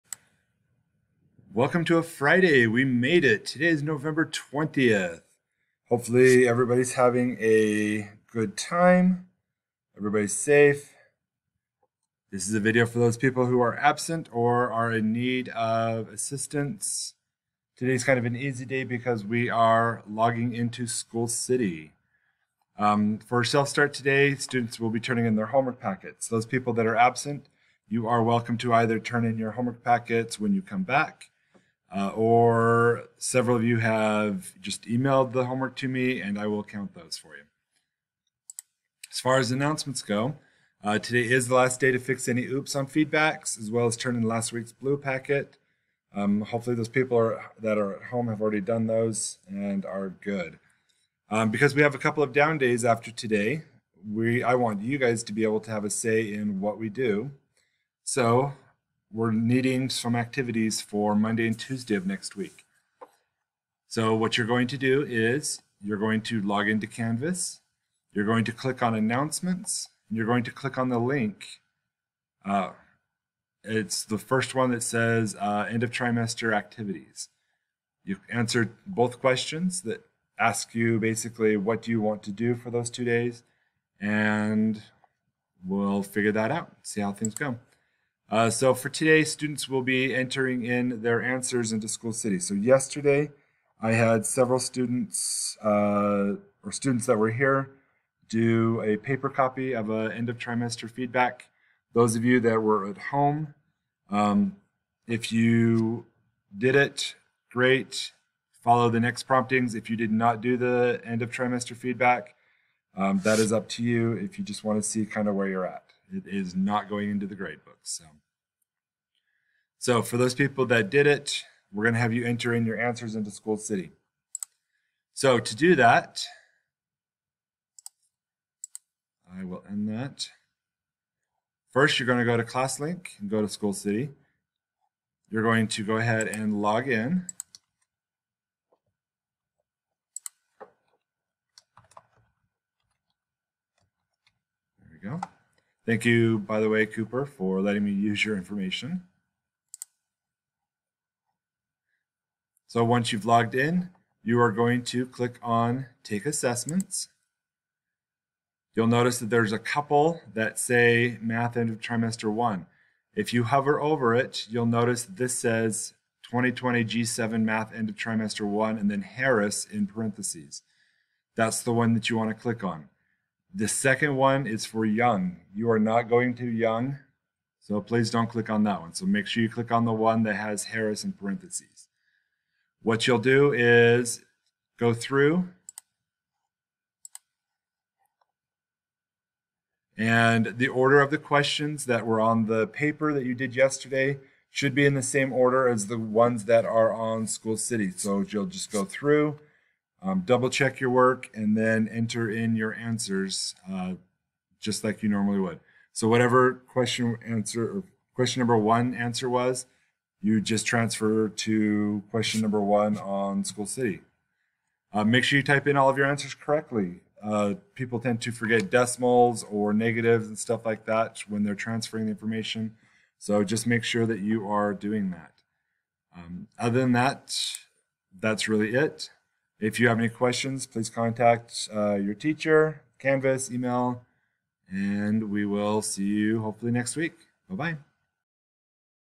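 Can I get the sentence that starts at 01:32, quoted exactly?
So yesterday, I had several students uh, or students that were here do a paper copy of an end of trimester feedback.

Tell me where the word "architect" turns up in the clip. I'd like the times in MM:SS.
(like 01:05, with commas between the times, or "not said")
not said.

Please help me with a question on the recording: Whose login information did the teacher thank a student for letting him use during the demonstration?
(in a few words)
Cooper.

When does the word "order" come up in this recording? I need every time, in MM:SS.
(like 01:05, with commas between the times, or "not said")
03:10, 03:15.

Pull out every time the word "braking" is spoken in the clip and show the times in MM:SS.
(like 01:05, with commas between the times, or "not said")
not said.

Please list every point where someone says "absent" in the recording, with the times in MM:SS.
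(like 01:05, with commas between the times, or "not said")
00:13, 00:26.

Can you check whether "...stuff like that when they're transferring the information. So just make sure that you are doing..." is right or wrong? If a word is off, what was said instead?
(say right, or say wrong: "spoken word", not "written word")
right.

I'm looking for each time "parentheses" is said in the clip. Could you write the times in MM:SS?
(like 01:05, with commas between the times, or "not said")
02:49, 03:01.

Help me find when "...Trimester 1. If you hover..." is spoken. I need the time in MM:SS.
02:41.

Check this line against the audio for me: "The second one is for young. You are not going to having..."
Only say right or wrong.
wrong.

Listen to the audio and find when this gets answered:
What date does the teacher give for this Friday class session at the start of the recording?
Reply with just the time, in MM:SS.
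00:03.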